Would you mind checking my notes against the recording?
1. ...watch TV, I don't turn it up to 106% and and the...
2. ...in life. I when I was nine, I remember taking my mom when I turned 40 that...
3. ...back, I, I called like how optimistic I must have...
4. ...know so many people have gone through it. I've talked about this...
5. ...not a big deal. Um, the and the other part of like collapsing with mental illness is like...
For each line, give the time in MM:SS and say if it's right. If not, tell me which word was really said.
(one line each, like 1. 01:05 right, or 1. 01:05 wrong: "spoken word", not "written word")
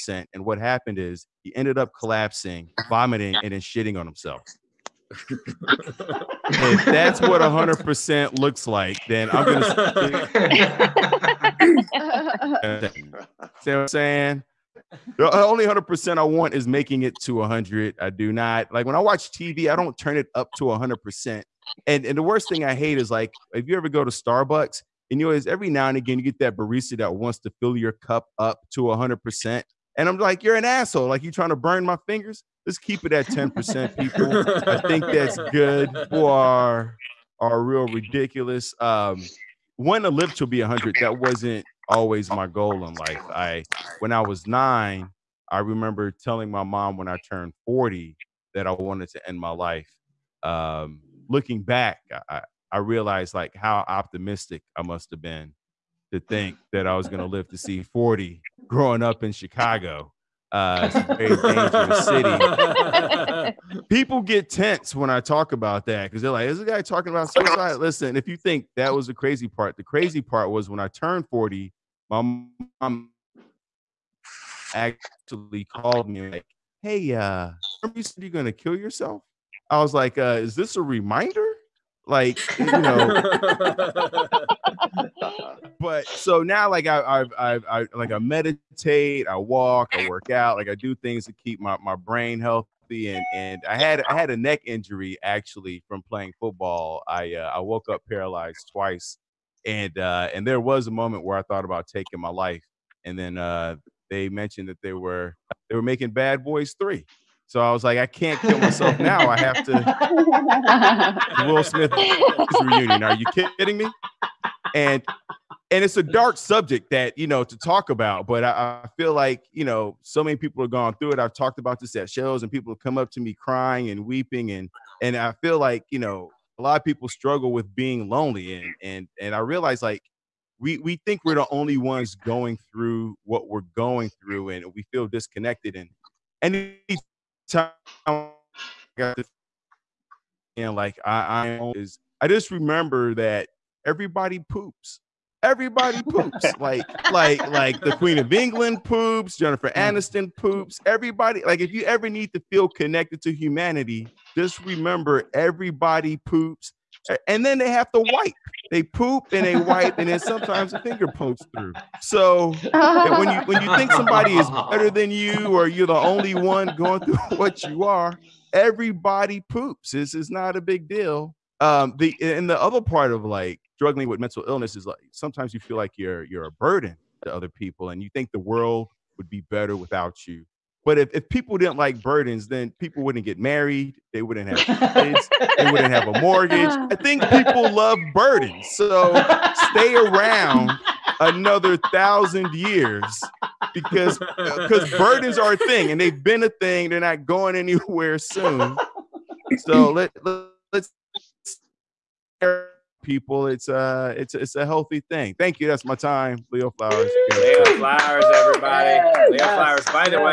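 1. 00:18 wrong: "100", not "106"
2. 00:42 wrong: "telling", not "taking"
3. 00:51 wrong: "realized", not "called"
4. 01:59 right
5. 02:50 wrong: "struggling", not "collapsing".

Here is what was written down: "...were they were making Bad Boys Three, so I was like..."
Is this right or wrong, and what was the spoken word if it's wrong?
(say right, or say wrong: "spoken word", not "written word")
right.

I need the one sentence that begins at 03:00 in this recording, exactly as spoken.
But if, if people didn't like burdens, then people wouldn't get married.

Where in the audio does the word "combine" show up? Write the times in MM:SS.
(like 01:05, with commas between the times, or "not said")
not said.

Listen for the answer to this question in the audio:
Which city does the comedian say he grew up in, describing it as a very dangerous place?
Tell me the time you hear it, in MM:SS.
00:59.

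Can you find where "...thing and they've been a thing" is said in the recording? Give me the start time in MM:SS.
03:15.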